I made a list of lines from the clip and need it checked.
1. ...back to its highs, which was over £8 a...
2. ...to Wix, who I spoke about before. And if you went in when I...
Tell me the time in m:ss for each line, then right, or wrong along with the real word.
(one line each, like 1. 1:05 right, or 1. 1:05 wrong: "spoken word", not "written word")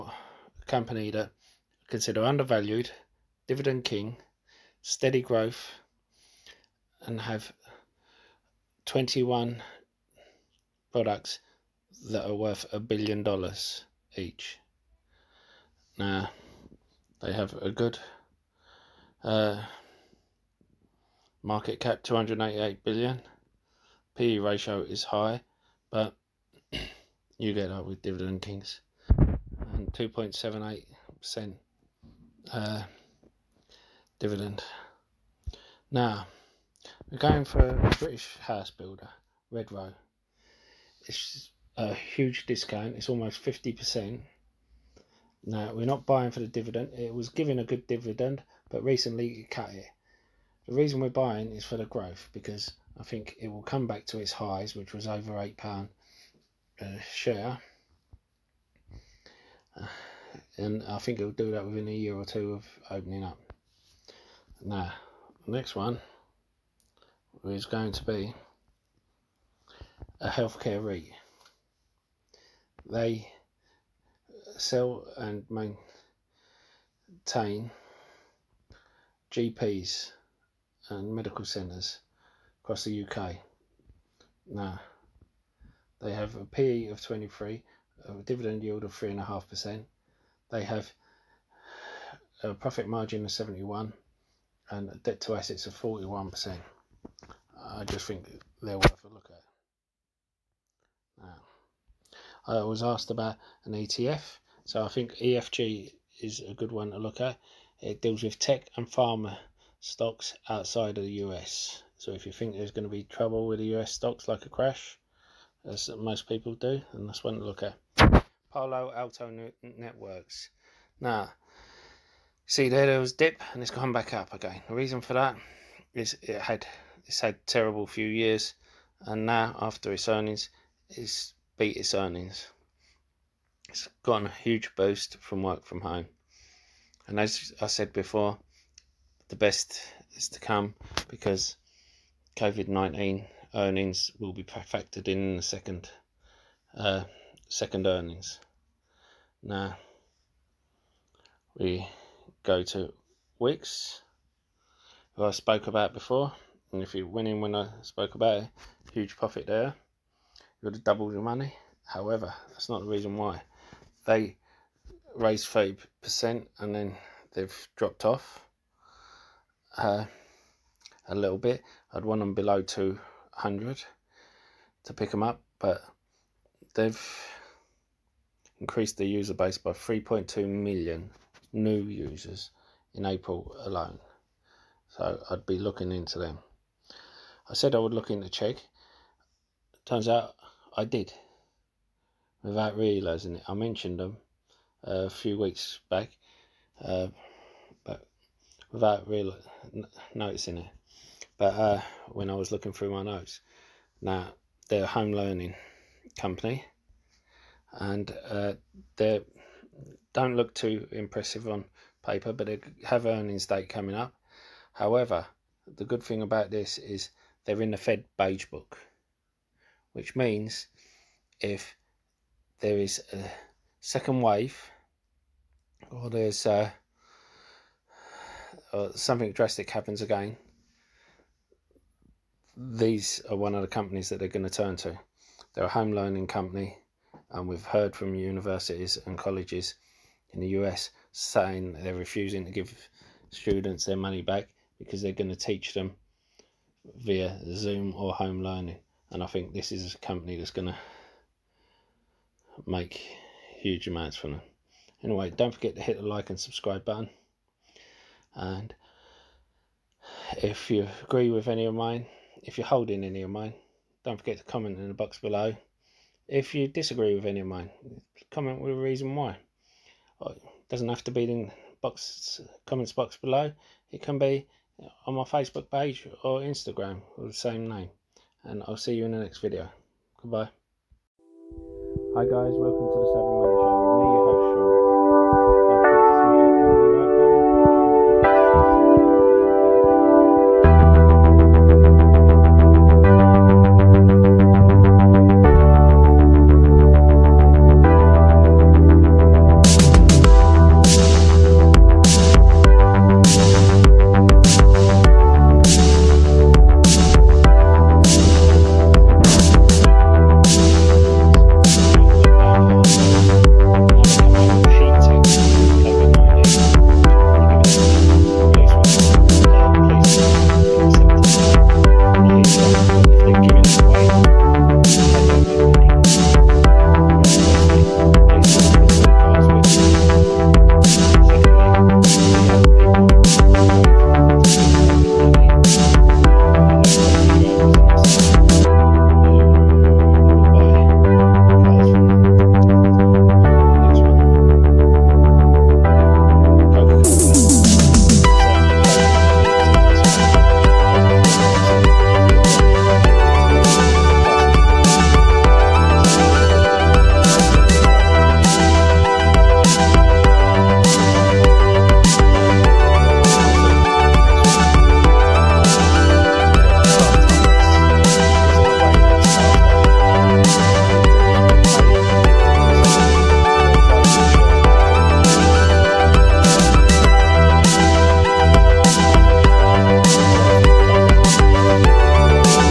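1. 0:53 right
2. 2:32 right.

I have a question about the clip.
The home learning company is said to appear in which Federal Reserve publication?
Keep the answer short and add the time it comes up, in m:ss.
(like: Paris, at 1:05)
Fed Beige Book, at 3:37.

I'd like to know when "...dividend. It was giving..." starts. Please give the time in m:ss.
0:46.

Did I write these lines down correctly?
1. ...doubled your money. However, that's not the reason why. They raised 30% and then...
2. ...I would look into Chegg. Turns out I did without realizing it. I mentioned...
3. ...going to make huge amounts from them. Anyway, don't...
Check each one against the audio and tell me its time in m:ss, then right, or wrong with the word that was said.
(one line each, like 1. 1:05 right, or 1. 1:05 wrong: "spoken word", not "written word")
1. 2:40 right
2. 3:07 right
3. 4:10 right.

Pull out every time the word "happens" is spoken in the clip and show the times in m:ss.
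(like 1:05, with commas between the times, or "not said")
3:49.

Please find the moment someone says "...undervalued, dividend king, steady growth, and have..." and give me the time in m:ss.
0:02.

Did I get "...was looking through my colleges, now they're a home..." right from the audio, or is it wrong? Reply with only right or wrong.
wrong.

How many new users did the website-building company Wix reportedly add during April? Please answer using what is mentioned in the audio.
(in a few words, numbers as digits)
3.2 million.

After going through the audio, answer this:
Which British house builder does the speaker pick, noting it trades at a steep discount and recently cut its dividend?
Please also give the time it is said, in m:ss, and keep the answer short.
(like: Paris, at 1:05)
Red Row, at 0:39.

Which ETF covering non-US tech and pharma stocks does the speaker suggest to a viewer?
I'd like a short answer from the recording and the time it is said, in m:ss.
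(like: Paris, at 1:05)
EFG, at 1:45.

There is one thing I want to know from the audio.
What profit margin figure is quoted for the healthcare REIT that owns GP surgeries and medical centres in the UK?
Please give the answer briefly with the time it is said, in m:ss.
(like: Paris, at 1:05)
71, at 1:33.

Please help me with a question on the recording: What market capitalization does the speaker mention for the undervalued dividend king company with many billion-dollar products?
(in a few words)
288 billion.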